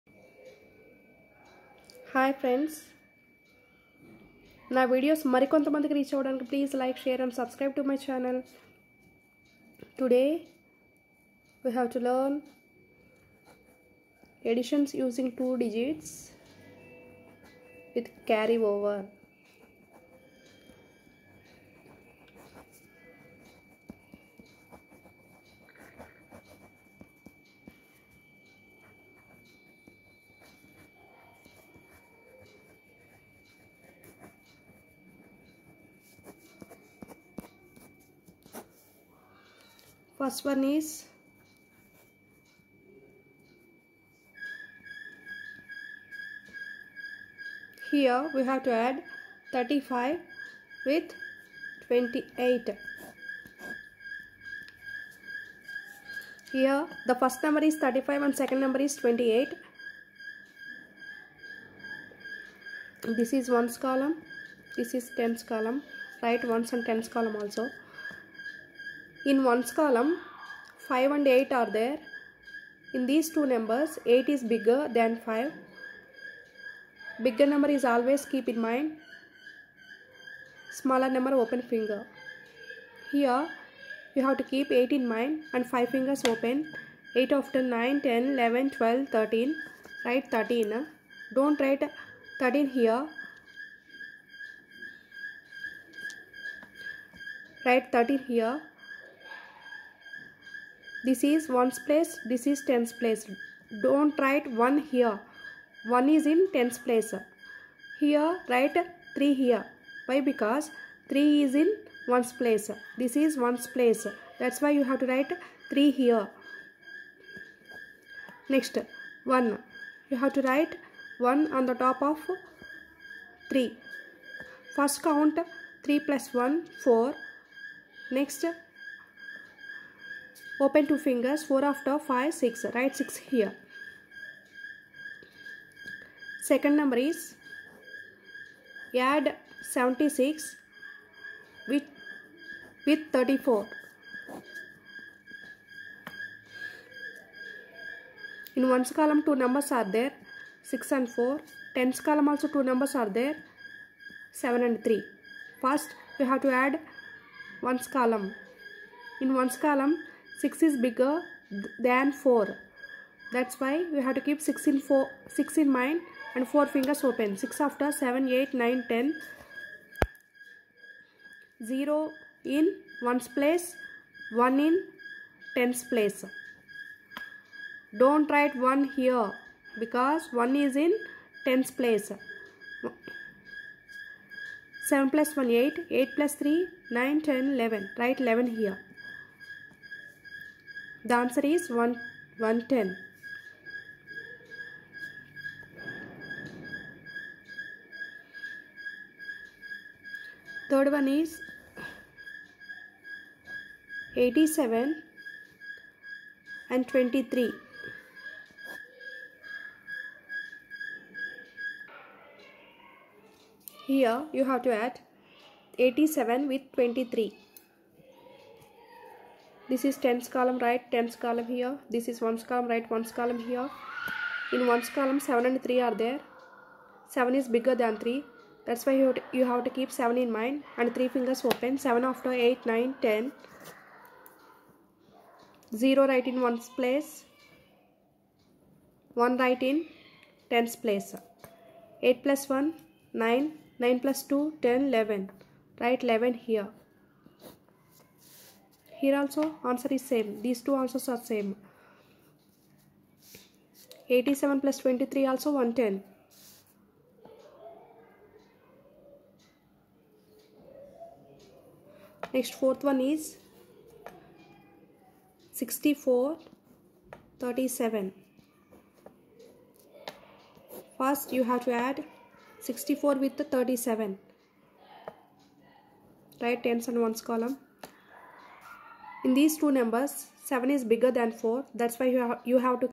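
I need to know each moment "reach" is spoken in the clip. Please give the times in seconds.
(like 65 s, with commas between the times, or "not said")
5 s.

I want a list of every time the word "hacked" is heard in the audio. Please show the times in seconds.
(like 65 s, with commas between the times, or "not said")
not said.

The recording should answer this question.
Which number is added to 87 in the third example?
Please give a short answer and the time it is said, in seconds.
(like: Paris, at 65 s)
23, at 204 s.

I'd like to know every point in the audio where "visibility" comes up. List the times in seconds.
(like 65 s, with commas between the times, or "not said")
not said.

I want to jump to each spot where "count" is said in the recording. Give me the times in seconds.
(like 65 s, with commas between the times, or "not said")
125 s.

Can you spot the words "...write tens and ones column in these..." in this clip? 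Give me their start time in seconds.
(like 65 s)
276 s.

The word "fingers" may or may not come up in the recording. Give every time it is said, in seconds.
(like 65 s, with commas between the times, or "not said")
81 s, 85 s, 131 s, 166 s, 231 s.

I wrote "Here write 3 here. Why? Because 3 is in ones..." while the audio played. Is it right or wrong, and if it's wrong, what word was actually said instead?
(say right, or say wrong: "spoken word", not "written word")
right.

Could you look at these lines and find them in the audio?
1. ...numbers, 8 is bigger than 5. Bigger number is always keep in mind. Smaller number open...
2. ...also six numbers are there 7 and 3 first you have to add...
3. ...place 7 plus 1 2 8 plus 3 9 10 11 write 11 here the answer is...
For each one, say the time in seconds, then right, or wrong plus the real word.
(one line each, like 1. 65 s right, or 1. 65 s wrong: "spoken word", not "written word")
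1. 73 s right
2. 152 s wrong: "two", not "six"
3. 181 s wrong: "8", not "2".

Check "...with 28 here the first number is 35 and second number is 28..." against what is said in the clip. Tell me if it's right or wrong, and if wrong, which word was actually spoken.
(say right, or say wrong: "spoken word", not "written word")
right.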